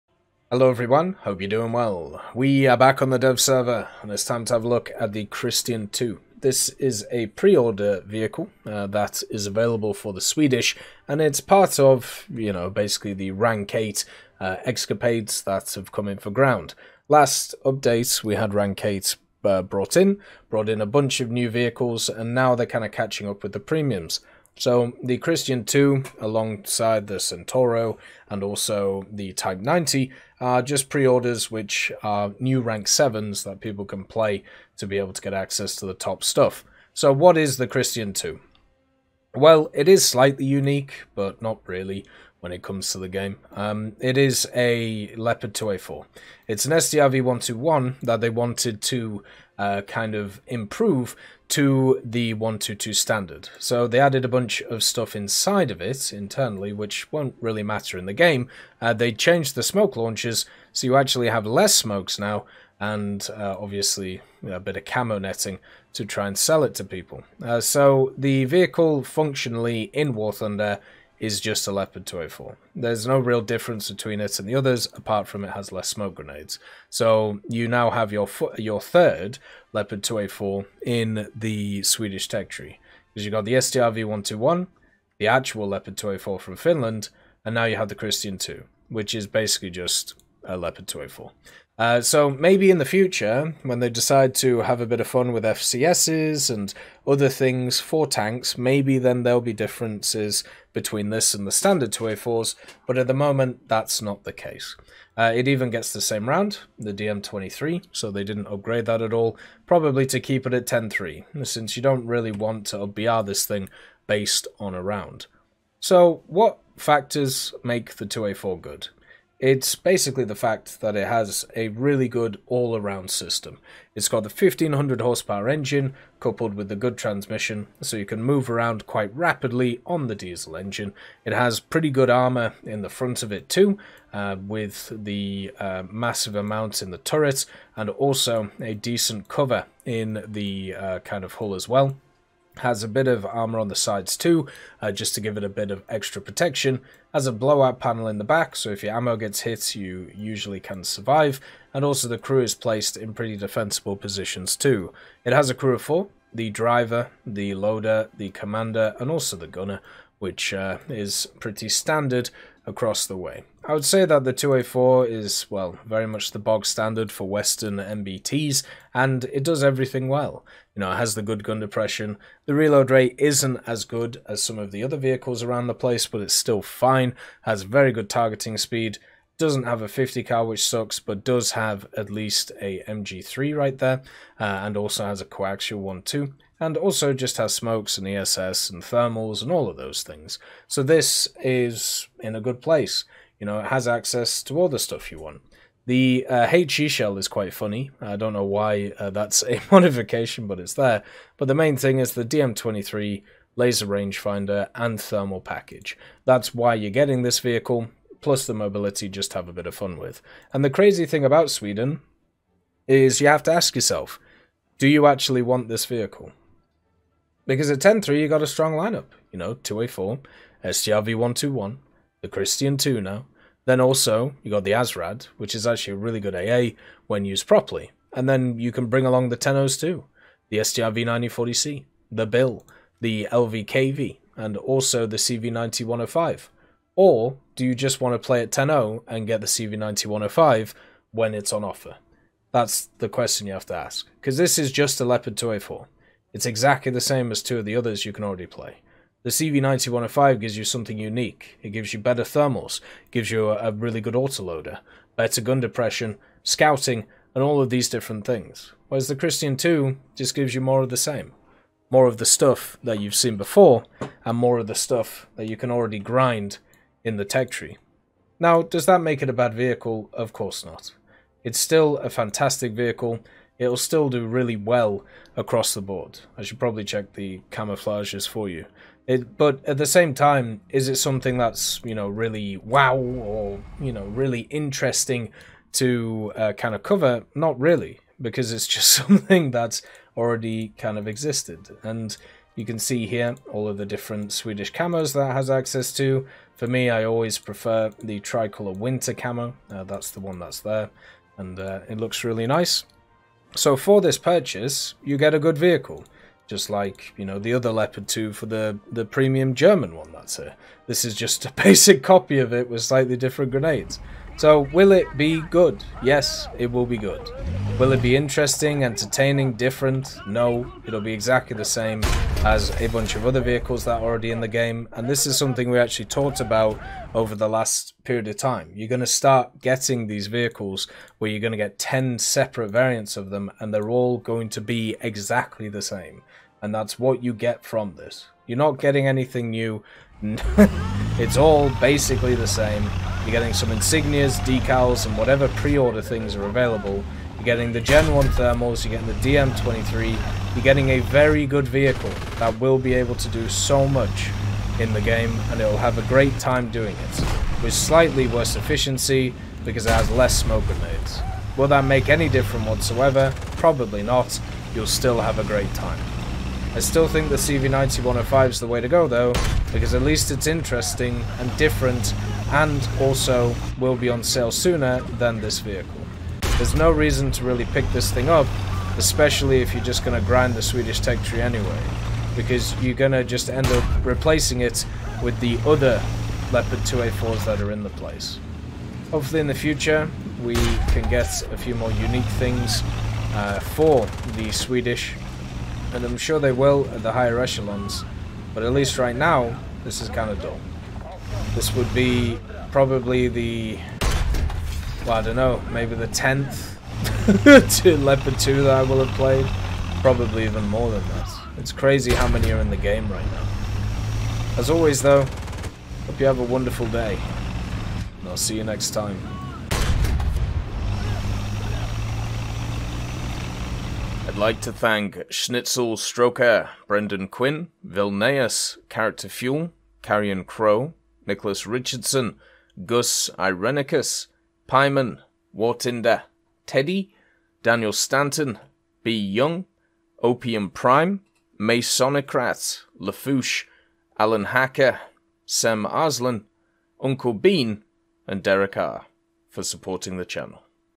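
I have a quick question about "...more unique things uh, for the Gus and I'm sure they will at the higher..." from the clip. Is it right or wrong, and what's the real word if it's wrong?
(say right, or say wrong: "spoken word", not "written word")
wrong: "Swedish", not "Gus".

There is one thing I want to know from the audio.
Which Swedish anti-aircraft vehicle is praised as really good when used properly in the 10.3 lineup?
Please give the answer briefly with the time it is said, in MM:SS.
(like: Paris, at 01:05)
ASRAD, at 03:44.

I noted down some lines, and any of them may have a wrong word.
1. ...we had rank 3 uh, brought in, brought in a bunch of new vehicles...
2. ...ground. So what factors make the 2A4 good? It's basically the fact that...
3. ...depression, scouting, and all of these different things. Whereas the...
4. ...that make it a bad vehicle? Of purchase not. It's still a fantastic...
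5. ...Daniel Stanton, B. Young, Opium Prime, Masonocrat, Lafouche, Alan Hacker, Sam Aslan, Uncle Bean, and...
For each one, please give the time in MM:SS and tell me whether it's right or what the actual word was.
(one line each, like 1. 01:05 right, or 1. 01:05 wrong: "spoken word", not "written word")
1. 00:18 wrong: "8", not "3"
2. 01:54 wrong: "round", not "ground"
3. 04:15 right
4. 04:28 wrong: "course", not "purchase"
5. 07:17 right.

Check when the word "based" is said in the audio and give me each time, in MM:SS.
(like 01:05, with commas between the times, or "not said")
01:54.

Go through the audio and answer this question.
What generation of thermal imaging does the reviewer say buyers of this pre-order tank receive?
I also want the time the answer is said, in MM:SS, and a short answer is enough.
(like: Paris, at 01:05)
Gen 1, at 05:47.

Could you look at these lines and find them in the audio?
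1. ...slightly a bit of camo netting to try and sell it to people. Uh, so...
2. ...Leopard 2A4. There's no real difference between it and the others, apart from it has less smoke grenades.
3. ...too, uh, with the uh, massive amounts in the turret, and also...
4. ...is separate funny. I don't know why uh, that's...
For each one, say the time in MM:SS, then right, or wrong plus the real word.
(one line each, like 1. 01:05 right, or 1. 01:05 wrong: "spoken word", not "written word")
1. 01:03 wrong: "obviously", not "slightly"
2. 01:11 right
3. 02:13 right
4. 03:17 wrong: "quite", not "separate".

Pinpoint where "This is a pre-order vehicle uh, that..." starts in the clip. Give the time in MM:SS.
00:06.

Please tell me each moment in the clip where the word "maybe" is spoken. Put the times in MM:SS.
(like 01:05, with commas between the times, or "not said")
01:32, 01:38, 06:45.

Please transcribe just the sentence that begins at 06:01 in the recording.
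Will that make any difference whatsoever?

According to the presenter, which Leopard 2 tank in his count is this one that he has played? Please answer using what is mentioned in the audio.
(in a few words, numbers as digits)
10th.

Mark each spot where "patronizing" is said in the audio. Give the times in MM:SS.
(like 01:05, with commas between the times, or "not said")
not said.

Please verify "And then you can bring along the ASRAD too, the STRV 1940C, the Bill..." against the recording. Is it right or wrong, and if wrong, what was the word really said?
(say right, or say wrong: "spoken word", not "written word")
wrong: "Tenos", not "ASRAD".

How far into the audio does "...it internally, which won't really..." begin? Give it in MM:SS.
00:55.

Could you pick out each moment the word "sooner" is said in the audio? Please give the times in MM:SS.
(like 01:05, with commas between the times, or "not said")
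06:14.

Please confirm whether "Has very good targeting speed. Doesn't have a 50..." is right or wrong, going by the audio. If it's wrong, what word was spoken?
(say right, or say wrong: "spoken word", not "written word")
right.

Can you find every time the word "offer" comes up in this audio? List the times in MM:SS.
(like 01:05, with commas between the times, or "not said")
04:01.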